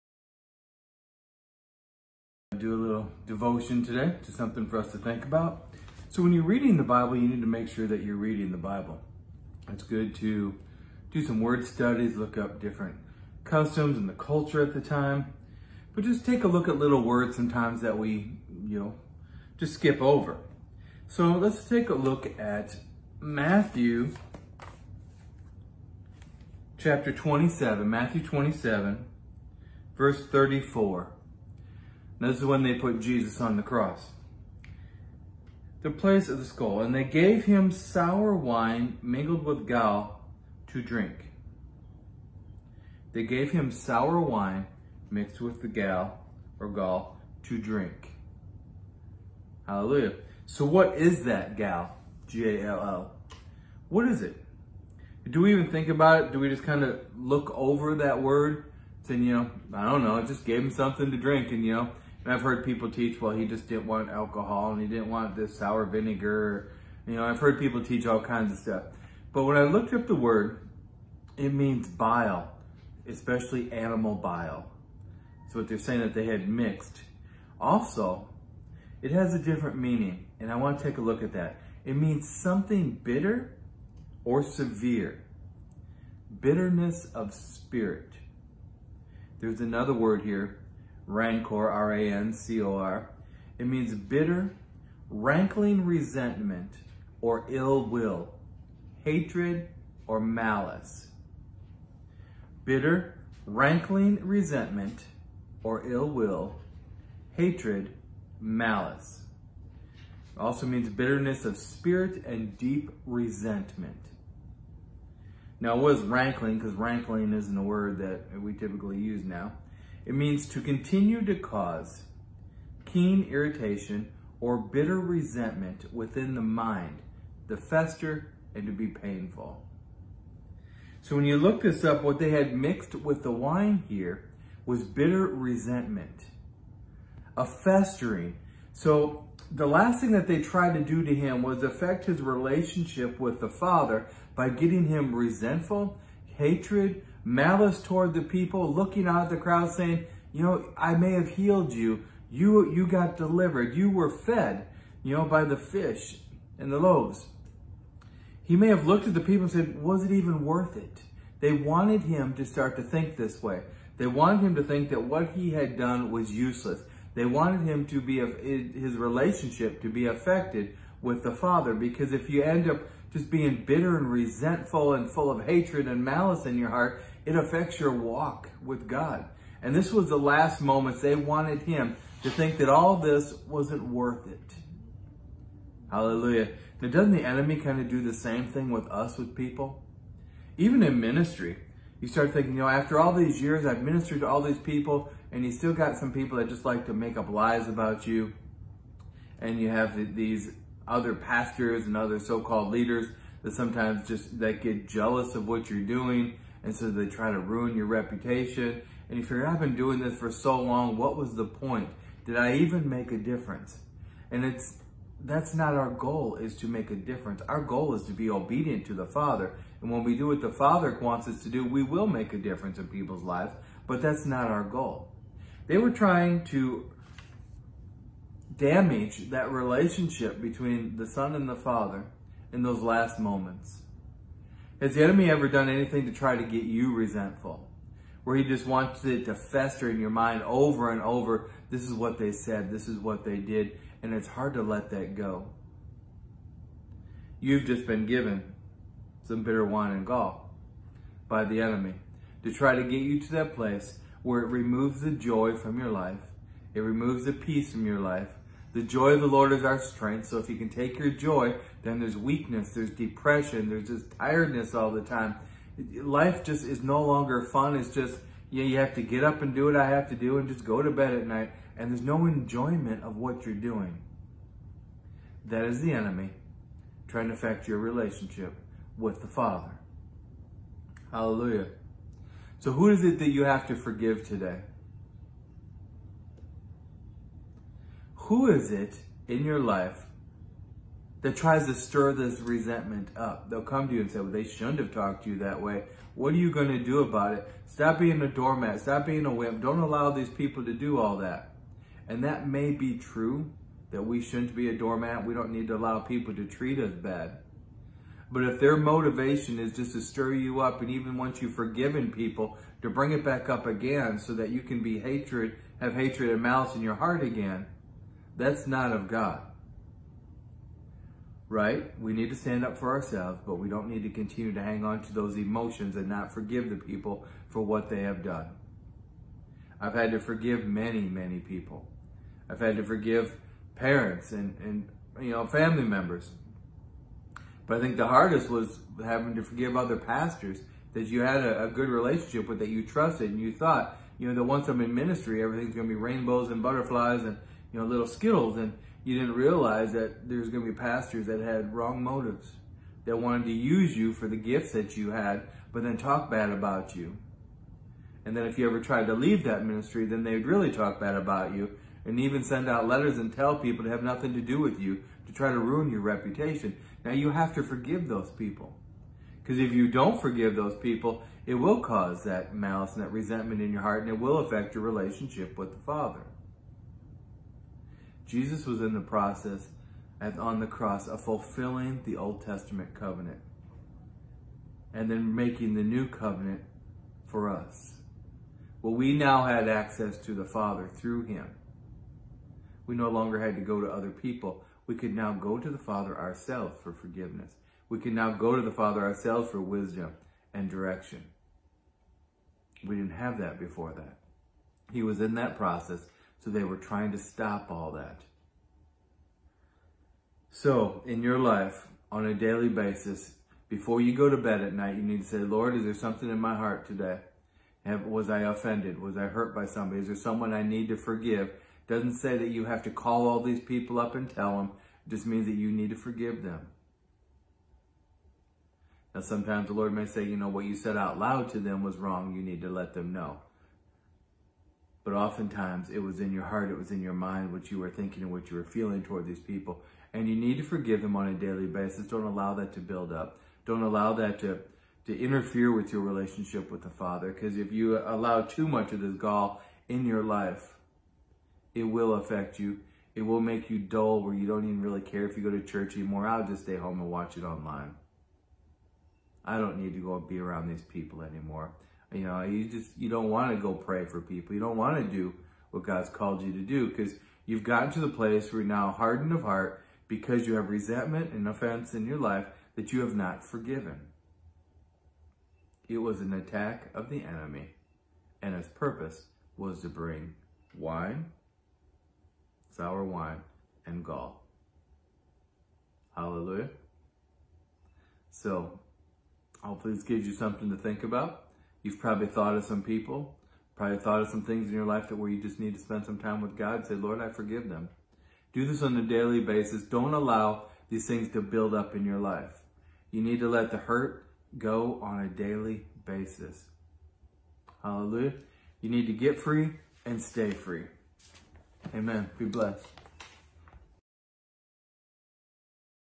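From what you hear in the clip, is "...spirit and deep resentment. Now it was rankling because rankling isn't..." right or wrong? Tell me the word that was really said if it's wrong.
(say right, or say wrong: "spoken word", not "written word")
right.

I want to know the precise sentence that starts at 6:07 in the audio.
Now you have to forgive those people.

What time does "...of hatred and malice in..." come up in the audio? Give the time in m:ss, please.
2:55.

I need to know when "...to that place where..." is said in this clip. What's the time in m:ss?
4:13.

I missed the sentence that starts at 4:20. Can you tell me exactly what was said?
So if you can take your joy, then there's weakness, there's depression, there's just tiredness all the time.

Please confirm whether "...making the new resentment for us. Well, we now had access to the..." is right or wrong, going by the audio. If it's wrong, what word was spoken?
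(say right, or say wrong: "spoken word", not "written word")
wrong: "covenant", not "resentment".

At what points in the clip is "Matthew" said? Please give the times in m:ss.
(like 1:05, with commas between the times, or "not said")
0:23, 0:27.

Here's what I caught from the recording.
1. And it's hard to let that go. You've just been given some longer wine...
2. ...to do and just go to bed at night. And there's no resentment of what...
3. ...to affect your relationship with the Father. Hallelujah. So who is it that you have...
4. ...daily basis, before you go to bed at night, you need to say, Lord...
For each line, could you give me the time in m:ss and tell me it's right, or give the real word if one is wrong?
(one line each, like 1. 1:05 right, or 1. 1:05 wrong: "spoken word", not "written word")
1. 4:04 wrong: "bitter", not "longer"
2. 4:30 wrong: "enjoyment", not "resentment"
3. 4:37 right
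4. 6:52 right.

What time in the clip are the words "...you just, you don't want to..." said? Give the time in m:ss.
7:42.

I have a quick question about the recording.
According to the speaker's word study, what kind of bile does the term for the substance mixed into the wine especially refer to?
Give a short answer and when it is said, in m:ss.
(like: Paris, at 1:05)
Animal bile, at 1:13.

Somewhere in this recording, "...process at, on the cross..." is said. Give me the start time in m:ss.
6:19.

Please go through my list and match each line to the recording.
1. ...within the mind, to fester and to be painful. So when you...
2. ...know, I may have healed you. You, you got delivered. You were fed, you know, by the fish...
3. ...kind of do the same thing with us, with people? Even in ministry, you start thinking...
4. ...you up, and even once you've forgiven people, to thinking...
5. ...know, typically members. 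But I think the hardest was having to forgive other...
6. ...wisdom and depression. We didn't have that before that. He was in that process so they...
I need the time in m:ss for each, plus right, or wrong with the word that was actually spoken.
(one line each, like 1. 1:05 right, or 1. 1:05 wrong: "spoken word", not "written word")
1. 2:05 right
2. 2:30 right
3. 3:07 right
4. 5:10 wrong: "bring", not "thinking"
5. 5:35 wrong: "family", not "typically"
6. 6:39 wrong: "direction", not "depression".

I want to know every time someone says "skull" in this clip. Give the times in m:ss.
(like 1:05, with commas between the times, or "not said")
0:36.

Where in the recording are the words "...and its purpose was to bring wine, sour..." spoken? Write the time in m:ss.
7:58.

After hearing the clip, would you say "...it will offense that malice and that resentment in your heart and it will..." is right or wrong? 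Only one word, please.
wrong.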